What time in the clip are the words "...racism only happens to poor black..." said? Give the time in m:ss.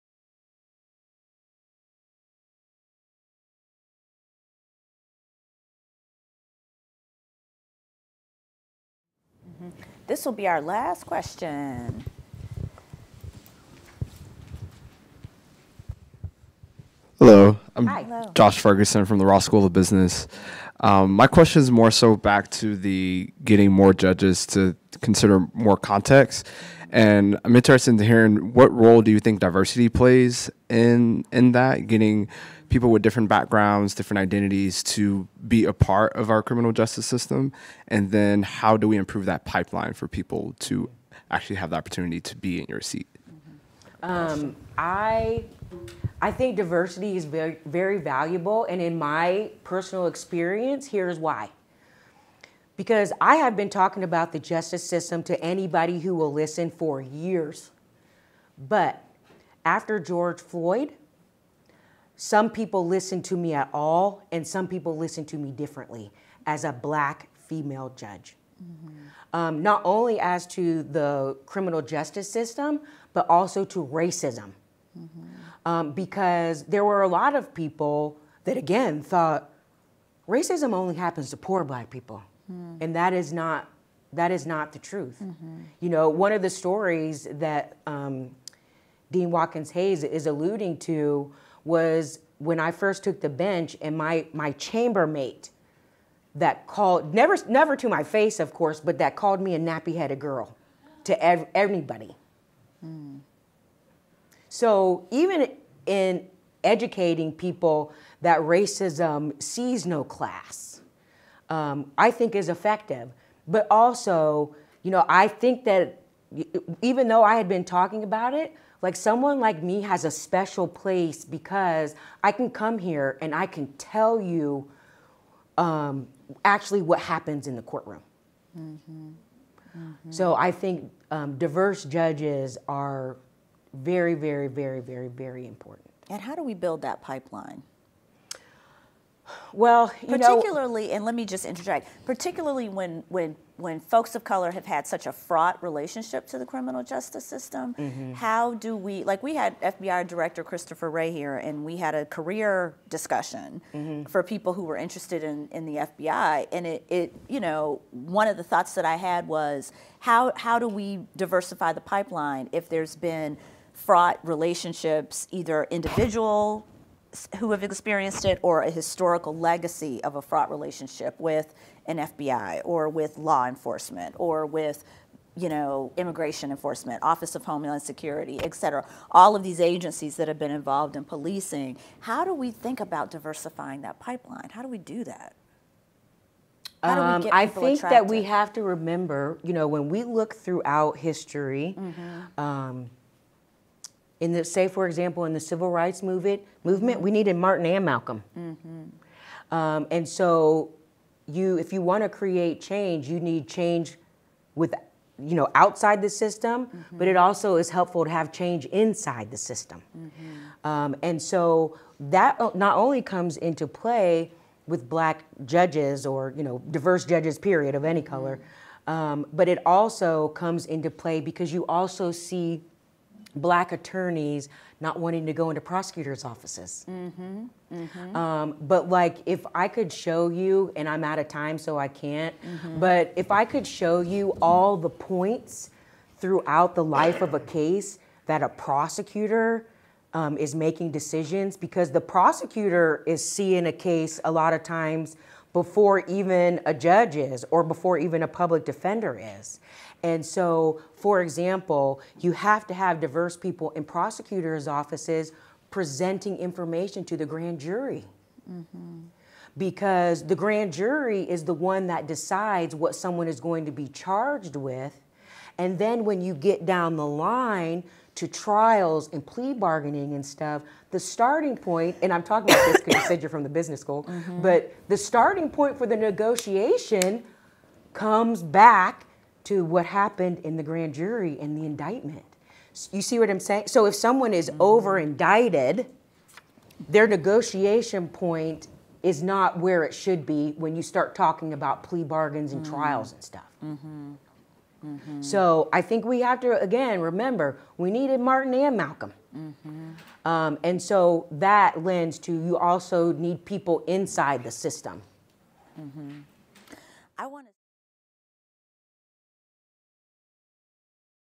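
1:20.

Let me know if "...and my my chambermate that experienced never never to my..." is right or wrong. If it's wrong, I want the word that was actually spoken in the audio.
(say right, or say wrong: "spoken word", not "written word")
wrong: "called", not "experienced".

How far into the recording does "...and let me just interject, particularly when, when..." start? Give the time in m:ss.
2:20.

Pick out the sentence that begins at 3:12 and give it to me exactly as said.
um, in the say for example in the civil rights movement movement we needed martin and malcolm mm-hmm.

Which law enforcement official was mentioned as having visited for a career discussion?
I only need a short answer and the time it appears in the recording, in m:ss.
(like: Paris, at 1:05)
Christopher Wray, at 2:30.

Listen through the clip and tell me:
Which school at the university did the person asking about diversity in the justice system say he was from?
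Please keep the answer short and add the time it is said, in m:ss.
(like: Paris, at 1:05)
Ross School of Business, at 0:19.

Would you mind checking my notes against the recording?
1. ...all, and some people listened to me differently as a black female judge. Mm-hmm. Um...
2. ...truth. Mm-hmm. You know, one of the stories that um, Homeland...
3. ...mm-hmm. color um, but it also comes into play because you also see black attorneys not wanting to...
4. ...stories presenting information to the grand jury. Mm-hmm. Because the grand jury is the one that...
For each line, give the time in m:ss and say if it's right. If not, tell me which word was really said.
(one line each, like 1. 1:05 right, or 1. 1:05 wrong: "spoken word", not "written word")
1. 1:03 right
2. 1:24 wrong: "Dean", not "Homeland"
3. 3:38 right
4. 4:14 wrong: "offices", not "stories".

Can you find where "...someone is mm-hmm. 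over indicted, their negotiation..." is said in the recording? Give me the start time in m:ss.
4:43.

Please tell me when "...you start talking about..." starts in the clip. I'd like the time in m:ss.
4:50.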